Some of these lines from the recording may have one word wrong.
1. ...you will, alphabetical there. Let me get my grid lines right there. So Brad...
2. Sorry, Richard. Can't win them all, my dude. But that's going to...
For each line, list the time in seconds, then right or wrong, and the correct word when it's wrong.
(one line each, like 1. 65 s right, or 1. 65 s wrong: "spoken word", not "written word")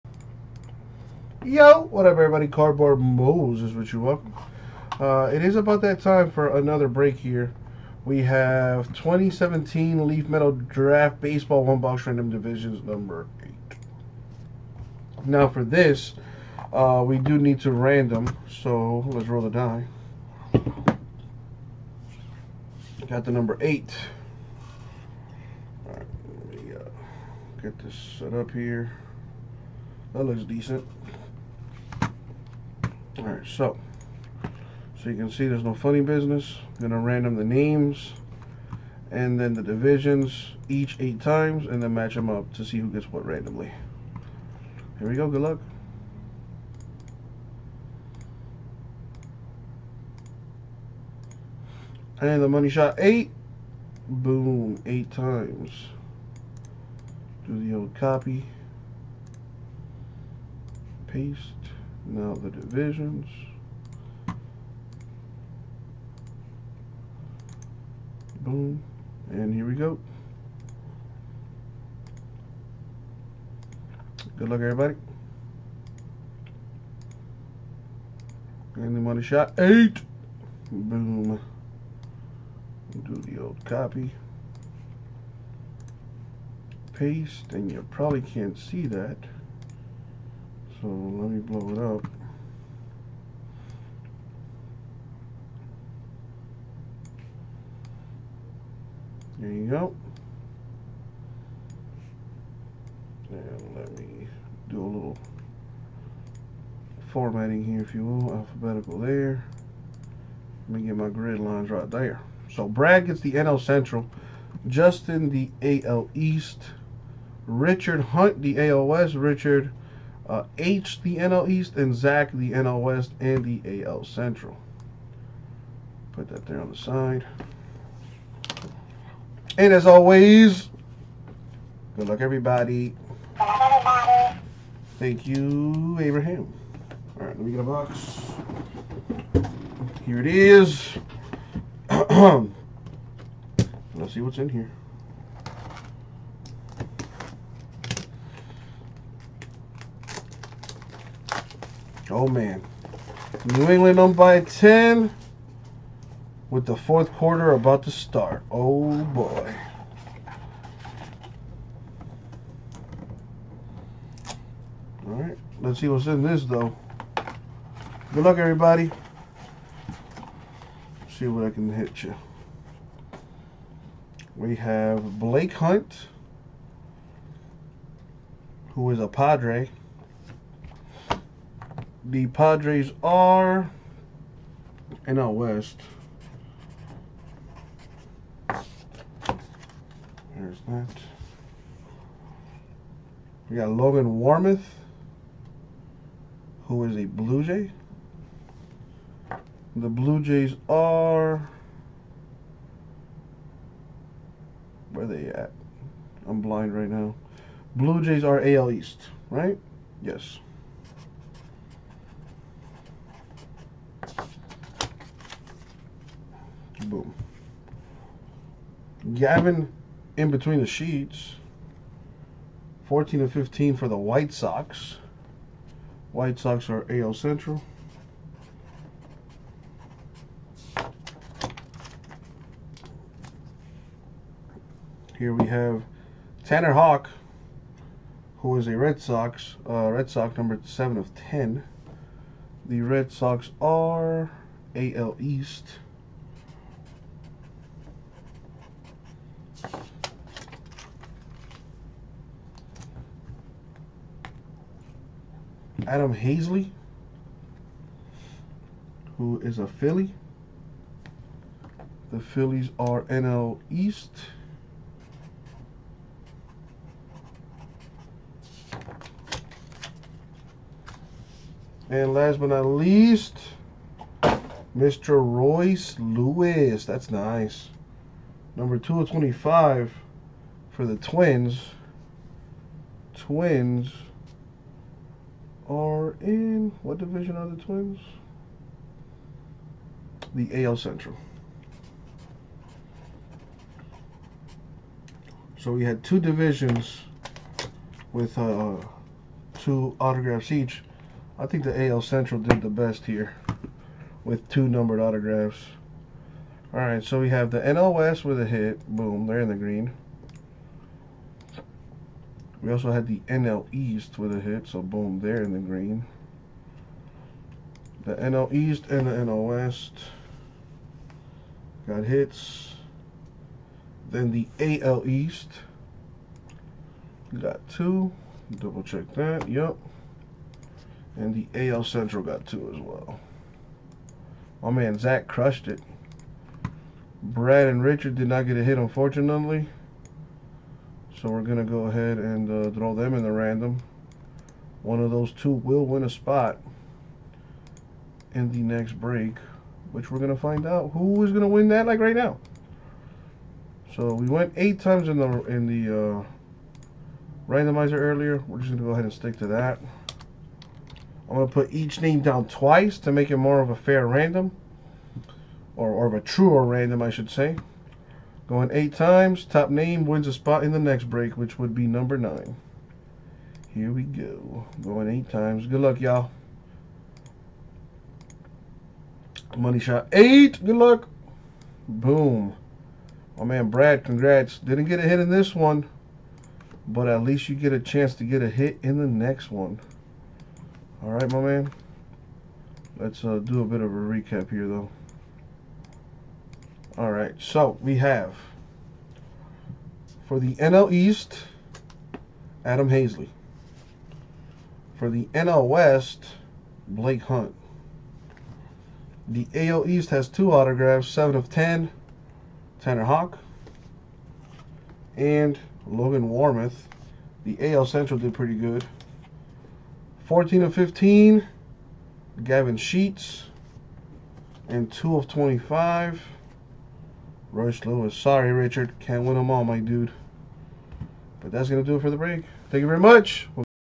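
1. 107 s right
2. 428 s right.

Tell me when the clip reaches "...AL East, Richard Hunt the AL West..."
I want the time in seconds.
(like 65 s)
115 s.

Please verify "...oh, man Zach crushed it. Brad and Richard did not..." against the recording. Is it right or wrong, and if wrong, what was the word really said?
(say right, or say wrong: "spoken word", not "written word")
right.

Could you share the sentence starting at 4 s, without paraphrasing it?
Uh, it is about that time for another break here.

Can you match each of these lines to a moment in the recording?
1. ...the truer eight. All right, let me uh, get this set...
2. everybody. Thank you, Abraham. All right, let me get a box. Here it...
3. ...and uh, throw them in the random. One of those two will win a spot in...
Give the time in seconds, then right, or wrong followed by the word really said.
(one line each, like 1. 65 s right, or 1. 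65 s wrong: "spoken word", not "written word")
1. 23 s wrong: "number", not "truer"
2. 133 s right
3. 342 s right.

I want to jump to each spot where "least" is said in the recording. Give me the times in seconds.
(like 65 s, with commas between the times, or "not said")
272 s, 387 s.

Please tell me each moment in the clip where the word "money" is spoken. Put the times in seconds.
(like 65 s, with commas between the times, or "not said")
52 s, 78 s, 379 s.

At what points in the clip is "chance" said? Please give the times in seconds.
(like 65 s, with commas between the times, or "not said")
387 s.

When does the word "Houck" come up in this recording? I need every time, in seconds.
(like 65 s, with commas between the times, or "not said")
236 s, 413 s.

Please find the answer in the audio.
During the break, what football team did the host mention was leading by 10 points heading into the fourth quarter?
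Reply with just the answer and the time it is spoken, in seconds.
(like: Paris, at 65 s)
New England, at 153 s.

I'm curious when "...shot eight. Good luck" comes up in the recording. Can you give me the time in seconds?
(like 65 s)
379 s.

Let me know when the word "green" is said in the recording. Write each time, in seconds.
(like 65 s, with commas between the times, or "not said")
309 s, 315 s.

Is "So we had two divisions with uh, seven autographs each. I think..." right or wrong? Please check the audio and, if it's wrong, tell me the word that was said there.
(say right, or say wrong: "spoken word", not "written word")
wrong: "two", not "seven".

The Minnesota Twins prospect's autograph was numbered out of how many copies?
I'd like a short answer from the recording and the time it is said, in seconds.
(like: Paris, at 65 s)
25, at 278 s.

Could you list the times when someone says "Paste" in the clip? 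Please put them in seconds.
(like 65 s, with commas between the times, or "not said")
61 s, 86 s.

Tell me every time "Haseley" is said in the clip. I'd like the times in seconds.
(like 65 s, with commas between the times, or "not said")
256 s, 402 s.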